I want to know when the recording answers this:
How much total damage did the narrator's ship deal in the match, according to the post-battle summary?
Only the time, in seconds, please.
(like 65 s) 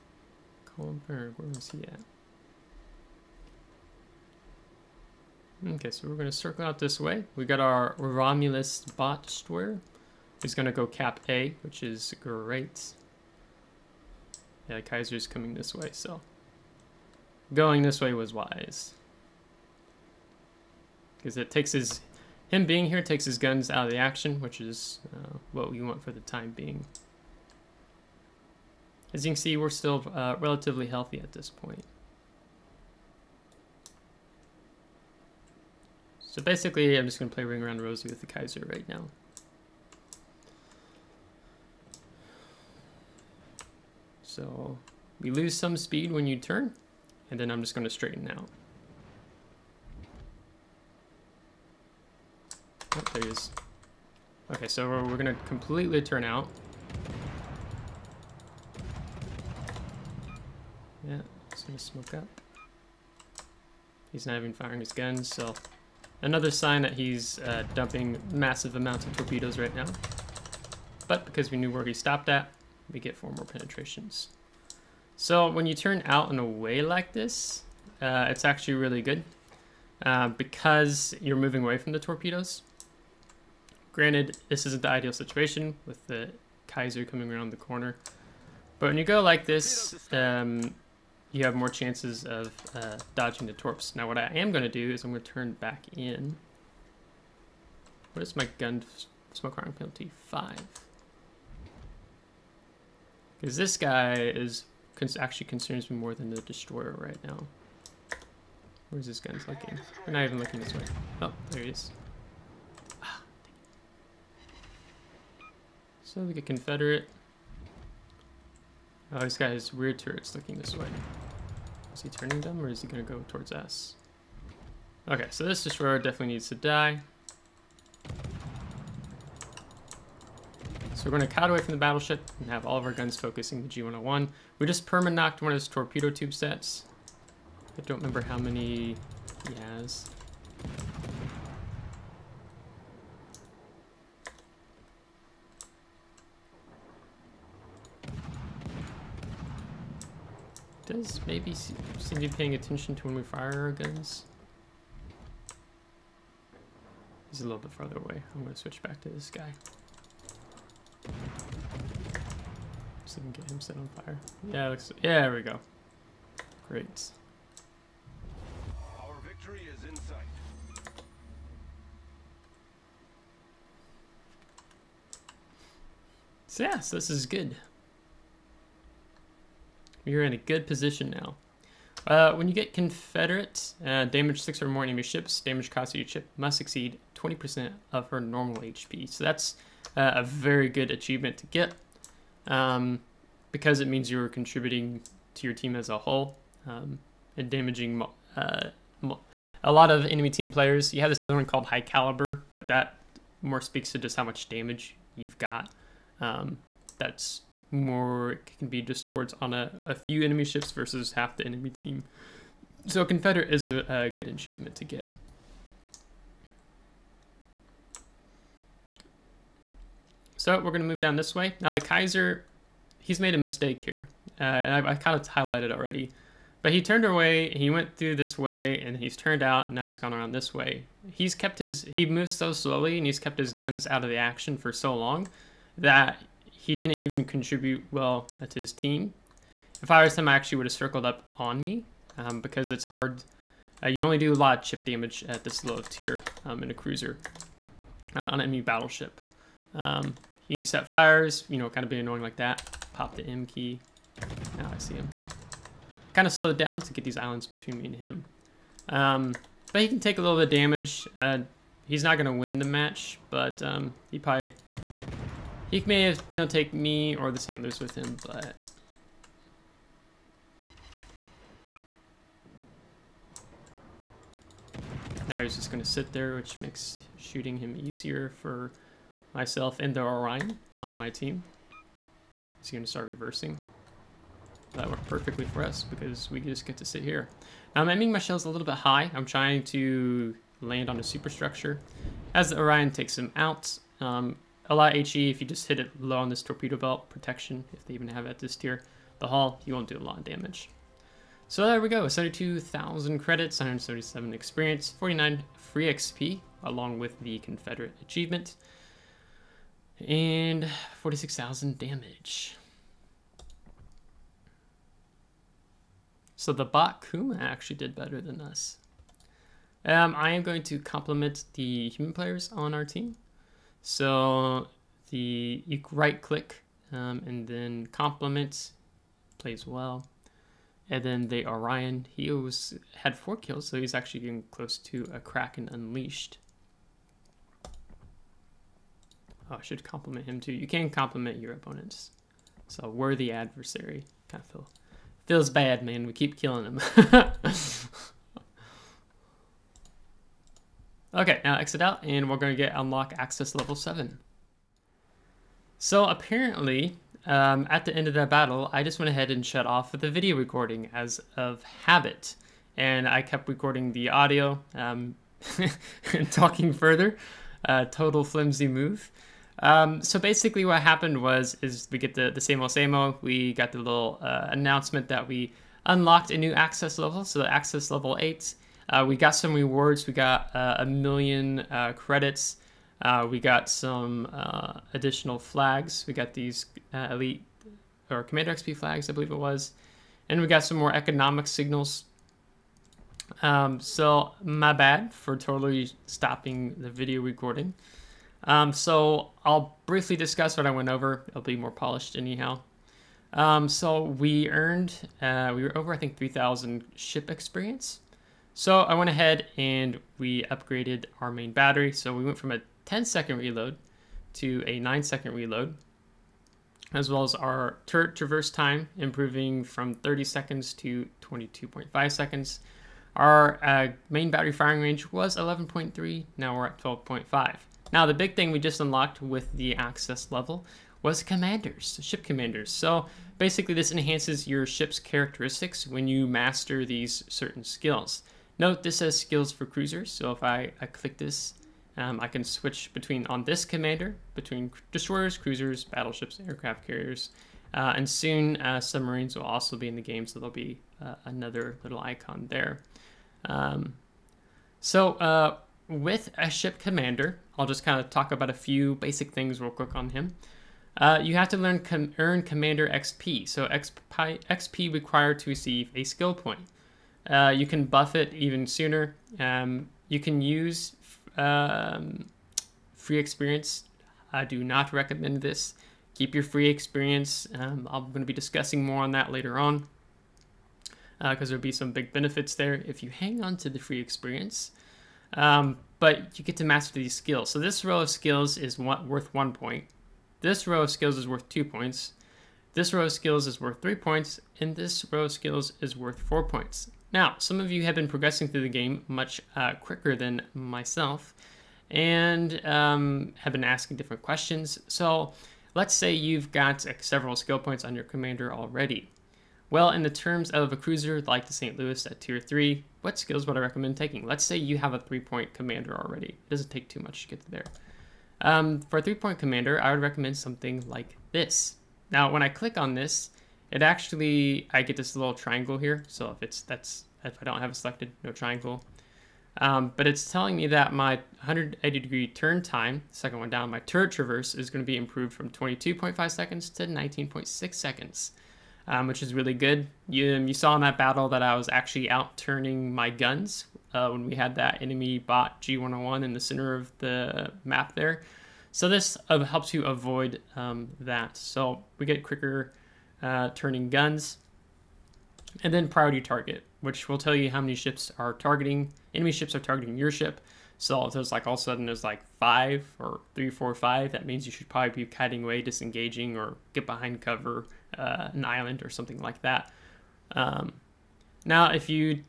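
311 s.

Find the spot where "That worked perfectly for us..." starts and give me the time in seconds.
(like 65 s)
284 s.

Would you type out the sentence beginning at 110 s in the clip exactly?
We're not even looking this way.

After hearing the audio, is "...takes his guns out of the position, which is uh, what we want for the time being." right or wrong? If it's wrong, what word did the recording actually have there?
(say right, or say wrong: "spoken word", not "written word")
wrong: "action", not "position".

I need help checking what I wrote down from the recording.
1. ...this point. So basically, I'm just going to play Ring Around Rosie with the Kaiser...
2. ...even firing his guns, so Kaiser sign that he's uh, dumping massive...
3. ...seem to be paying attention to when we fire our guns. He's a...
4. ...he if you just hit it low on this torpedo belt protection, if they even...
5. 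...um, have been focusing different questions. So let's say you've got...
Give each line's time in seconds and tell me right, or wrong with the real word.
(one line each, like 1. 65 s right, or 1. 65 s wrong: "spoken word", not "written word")
1. 31 s right
2. 64 s wrong: "Another", not "Kaiser"
3. 151 s right
4. 294 s right
5. 502 s wrong: "asking", not "focusing".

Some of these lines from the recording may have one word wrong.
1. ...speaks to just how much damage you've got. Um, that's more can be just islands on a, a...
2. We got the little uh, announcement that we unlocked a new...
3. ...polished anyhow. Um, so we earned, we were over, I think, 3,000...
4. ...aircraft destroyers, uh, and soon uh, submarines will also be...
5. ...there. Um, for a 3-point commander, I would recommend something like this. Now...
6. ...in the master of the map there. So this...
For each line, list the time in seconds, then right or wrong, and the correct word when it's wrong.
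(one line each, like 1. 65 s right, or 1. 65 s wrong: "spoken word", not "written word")
1. 203 s wrong: "towards", not "islands"
2. 373 s right
3. 401 s right
4. 446 s wrong: "carriers", not "destroyers"
5. 517 s right
6. 546 s wrong: "center", not "master".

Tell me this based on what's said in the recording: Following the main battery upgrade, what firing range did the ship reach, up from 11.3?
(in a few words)
12.5.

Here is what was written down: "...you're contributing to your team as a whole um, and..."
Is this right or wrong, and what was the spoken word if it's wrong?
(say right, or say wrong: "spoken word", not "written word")
right.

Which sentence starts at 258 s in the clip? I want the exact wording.
Um, but he can take a little bit of damage.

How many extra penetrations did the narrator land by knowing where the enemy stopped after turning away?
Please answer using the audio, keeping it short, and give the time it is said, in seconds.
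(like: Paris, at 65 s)
4, at 73 s.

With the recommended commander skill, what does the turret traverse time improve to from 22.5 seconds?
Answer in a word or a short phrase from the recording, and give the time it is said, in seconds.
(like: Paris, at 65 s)
19.6 seconds, at 536 s.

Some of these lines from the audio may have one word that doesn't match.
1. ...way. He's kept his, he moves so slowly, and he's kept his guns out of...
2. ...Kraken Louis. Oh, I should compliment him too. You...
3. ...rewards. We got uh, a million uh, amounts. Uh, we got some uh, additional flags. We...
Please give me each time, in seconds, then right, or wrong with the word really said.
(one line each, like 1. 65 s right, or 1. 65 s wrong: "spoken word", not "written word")
1. 230 s right
2. 335 s wrong: "Unleashed", not "Louis"
3. 379 s wrong: "credits", not "amounts".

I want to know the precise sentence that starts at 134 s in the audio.
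We just perma-knocked one of his torpedo tube sets.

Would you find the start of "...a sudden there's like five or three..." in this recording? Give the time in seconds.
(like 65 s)
561 s.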